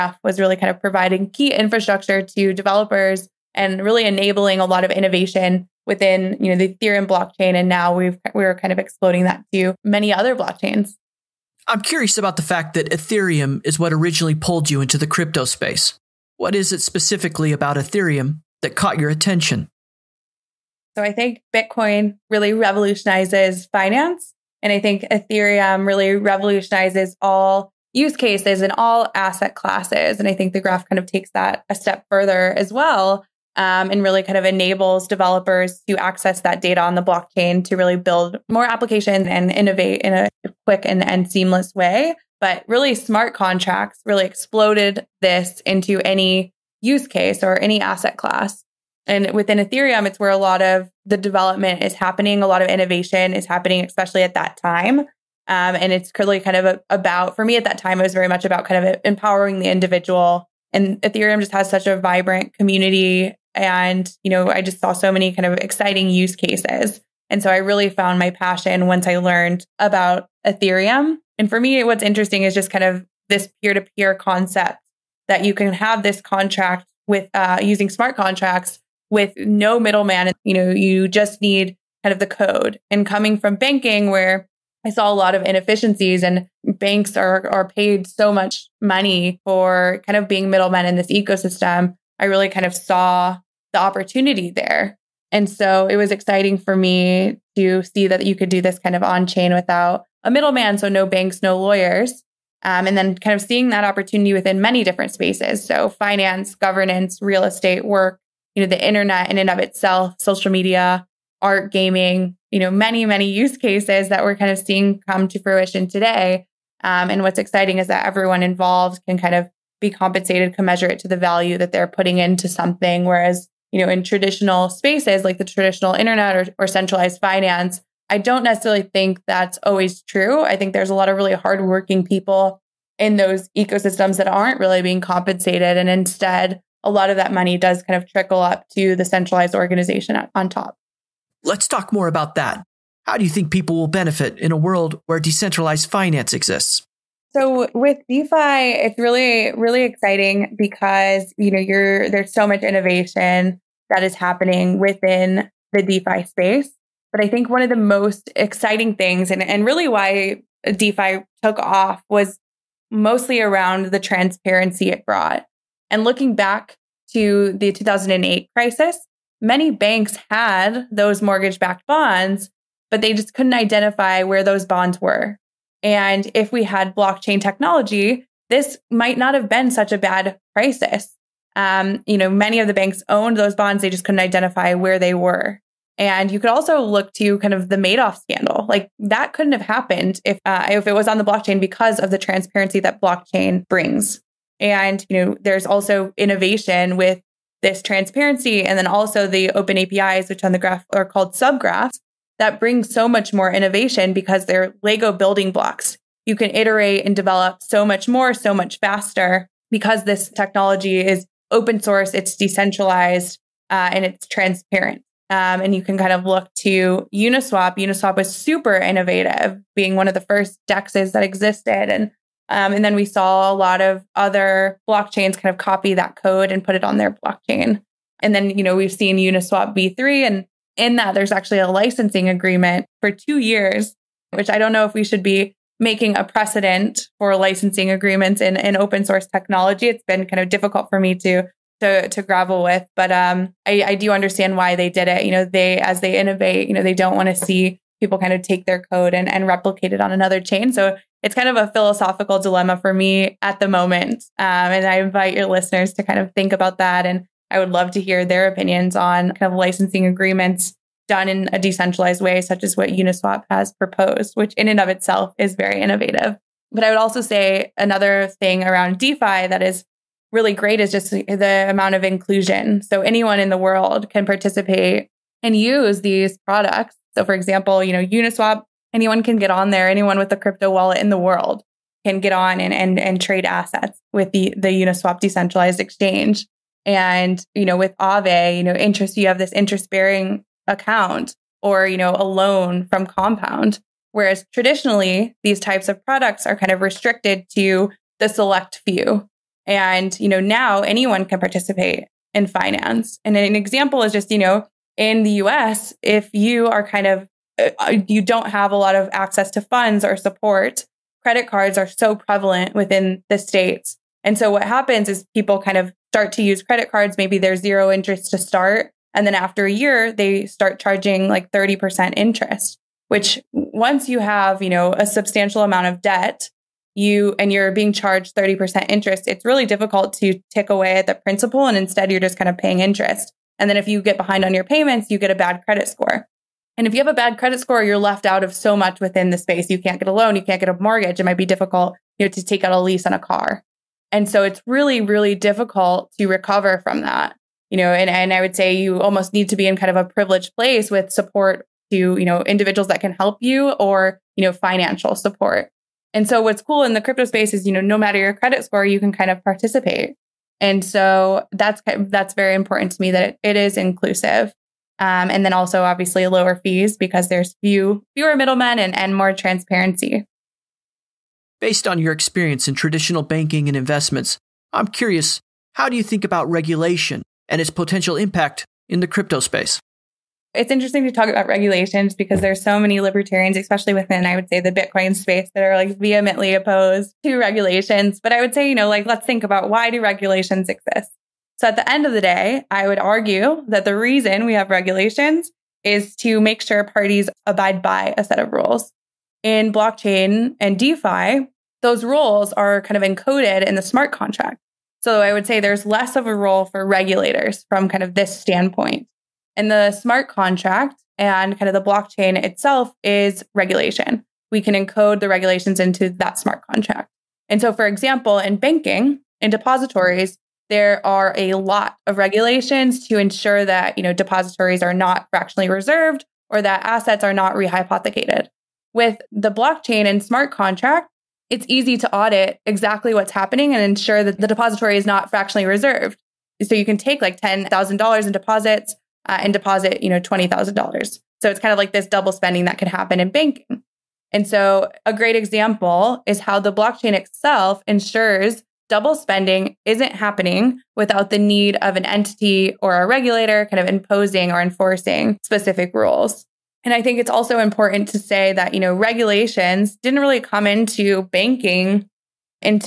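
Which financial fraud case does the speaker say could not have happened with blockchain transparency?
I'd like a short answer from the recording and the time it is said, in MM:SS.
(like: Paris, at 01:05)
Madoff scandal, at 03:07.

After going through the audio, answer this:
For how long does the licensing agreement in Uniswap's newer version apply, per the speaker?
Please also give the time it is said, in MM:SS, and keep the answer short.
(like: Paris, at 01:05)
2 years, at 03:53.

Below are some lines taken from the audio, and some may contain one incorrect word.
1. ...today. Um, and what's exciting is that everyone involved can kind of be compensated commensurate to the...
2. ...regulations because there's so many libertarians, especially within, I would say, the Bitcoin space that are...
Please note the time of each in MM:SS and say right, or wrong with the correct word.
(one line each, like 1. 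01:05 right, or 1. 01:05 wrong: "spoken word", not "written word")
1. 01:55 right
2. 06:21 right.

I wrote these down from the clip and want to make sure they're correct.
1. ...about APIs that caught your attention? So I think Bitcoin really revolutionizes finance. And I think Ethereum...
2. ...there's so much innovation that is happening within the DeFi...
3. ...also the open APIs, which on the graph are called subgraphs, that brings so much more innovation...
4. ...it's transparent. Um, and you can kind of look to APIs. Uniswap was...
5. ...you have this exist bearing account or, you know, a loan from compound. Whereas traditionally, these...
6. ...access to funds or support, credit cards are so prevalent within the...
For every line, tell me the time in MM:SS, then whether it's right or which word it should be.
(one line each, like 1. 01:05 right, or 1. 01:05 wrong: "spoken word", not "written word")
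1. 00:17 wrong: "Ethereum", not "APIs"
2. 02:32 right
3. 03:18 right
4. 03:34 wrong: "Uniswap", not "APIs"
5. 04:49 wrong: "interest", not "exist"
6. 05:09 right.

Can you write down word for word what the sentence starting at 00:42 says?
But really, smart contracts really exploded this into any use case or any asset class.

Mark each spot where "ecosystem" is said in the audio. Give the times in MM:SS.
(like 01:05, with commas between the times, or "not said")
01:31, 02:13.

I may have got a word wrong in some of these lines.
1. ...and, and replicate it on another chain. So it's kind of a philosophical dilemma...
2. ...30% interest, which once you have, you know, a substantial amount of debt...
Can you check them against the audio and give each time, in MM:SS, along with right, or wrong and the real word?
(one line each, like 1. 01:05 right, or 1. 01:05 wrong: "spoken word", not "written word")
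1. 04:09 right
2. 05:21 right.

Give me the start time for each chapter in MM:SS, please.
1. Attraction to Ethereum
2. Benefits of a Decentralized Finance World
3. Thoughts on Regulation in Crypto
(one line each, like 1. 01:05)
1. 00:11
2. 02:21
3. 06:11.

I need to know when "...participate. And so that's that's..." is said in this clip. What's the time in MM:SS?
05:59.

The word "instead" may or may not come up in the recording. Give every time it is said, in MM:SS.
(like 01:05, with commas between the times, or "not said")
02:15, 05:31.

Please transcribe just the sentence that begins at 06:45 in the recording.
So I would say there's less of a role for regulators from kind of this standpoint.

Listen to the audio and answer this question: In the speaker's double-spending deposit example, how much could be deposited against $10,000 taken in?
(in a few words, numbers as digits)
$20,000.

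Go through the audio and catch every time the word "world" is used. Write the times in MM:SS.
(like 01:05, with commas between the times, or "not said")
02:24, 04:33, 04:41.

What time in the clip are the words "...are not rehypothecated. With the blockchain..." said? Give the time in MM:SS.
07:07.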